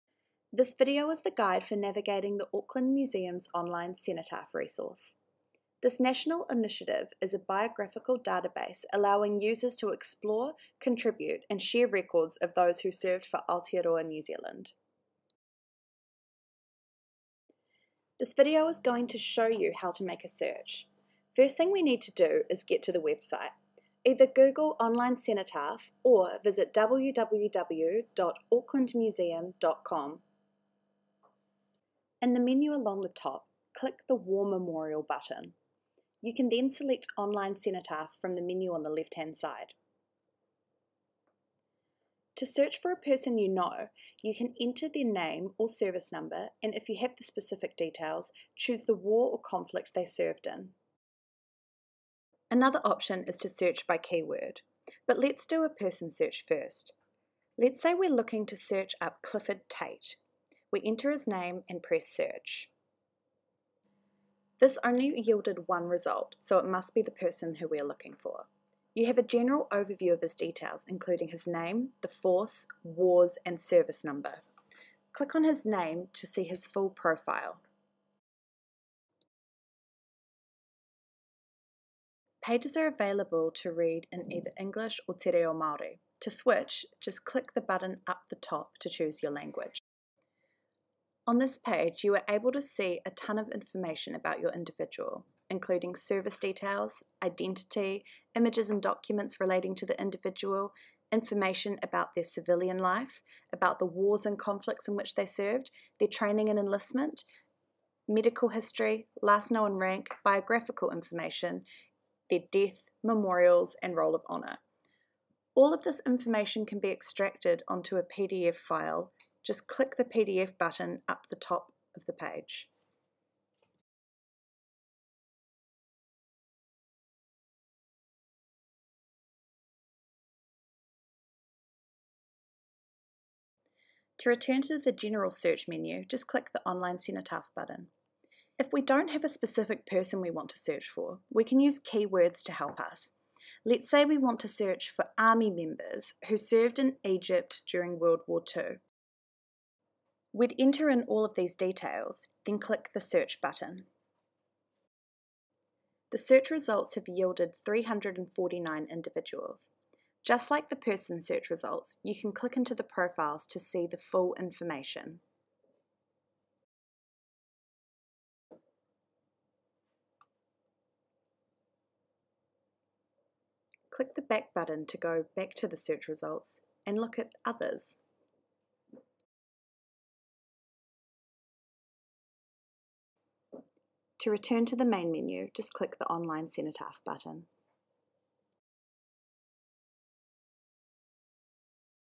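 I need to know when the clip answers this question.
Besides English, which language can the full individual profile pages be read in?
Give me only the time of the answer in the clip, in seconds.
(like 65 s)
85 s.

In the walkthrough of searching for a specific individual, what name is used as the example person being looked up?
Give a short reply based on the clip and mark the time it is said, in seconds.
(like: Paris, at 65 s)
Clifford Tate, at 59 s.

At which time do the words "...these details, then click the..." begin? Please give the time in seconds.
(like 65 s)
151 s.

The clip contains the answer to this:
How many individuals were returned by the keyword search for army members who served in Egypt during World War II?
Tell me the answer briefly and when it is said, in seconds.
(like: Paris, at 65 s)
349, at 157 s.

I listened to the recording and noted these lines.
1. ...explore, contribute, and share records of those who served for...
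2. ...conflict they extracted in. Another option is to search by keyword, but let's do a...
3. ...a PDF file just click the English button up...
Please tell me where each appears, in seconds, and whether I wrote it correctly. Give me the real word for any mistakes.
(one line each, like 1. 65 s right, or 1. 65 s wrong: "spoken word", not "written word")
1. 9 s right
2. 49 s wrong: "served", not "extracted"
3. 117 s wrong: "PDF", not "English".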